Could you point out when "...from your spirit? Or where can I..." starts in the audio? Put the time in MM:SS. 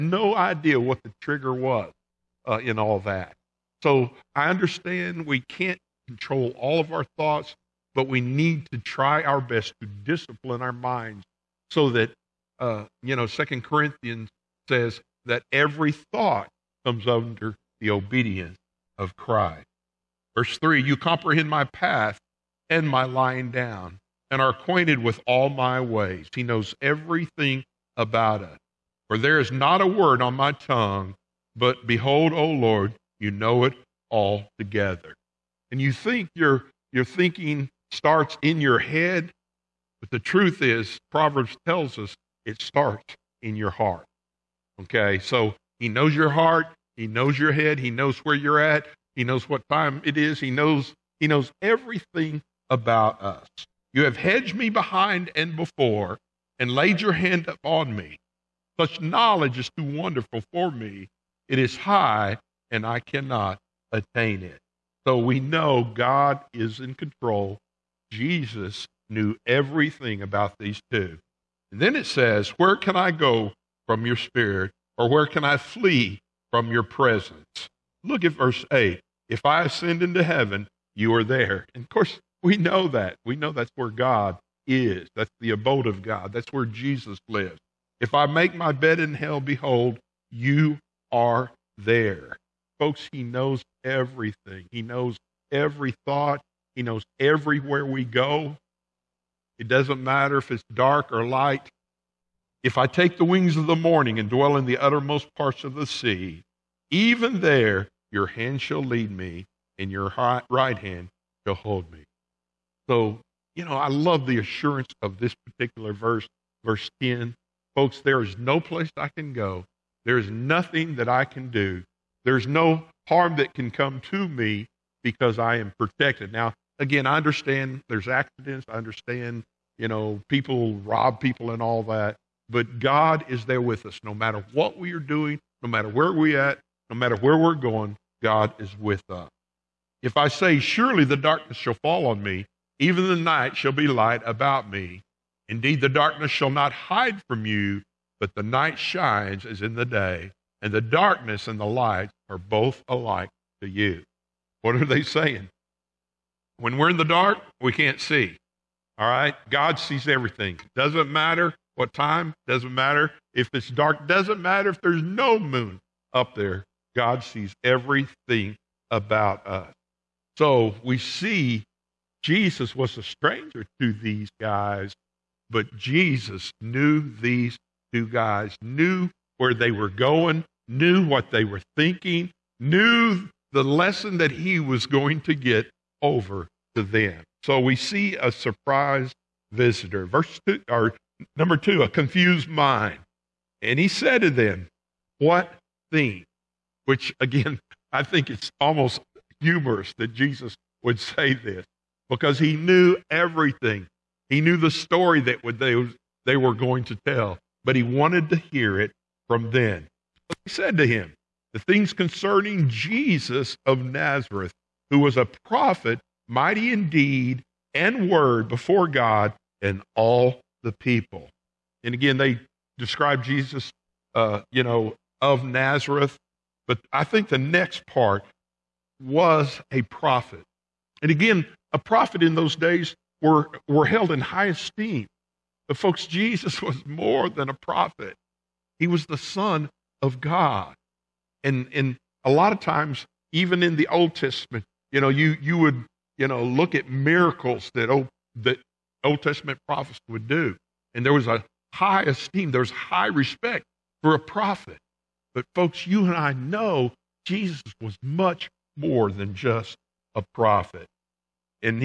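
01:13.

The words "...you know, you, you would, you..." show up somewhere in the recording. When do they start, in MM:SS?
04:04.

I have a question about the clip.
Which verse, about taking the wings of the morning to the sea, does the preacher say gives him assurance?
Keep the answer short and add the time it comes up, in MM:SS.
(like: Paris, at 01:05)
10, at 01:56.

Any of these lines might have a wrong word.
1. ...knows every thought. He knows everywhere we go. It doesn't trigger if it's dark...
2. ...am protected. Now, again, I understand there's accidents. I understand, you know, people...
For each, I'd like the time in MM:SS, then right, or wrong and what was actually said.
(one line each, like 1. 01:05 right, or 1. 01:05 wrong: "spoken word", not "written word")
1. 01:34 wrong: "matter", not "trigger"
2. 02:05 right.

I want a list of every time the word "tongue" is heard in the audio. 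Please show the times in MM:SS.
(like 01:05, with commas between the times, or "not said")
00:30.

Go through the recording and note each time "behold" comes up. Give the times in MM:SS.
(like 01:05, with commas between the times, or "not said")
00:31, 01:29.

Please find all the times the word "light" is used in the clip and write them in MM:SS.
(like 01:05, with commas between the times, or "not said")
01:41, 02:23, 02:31.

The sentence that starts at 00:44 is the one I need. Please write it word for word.
Okay, so he knows your heart, he knows your head.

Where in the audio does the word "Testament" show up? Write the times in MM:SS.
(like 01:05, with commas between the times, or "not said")
04:04, 04:09.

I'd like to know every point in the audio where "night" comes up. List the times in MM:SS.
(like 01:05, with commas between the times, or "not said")
02:23, 02:28.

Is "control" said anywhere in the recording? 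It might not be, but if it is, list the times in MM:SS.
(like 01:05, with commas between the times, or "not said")
00:06, 01:06.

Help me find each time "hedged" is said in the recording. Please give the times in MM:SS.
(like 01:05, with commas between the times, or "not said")
00:54.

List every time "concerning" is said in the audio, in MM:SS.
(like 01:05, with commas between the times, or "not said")
03:31.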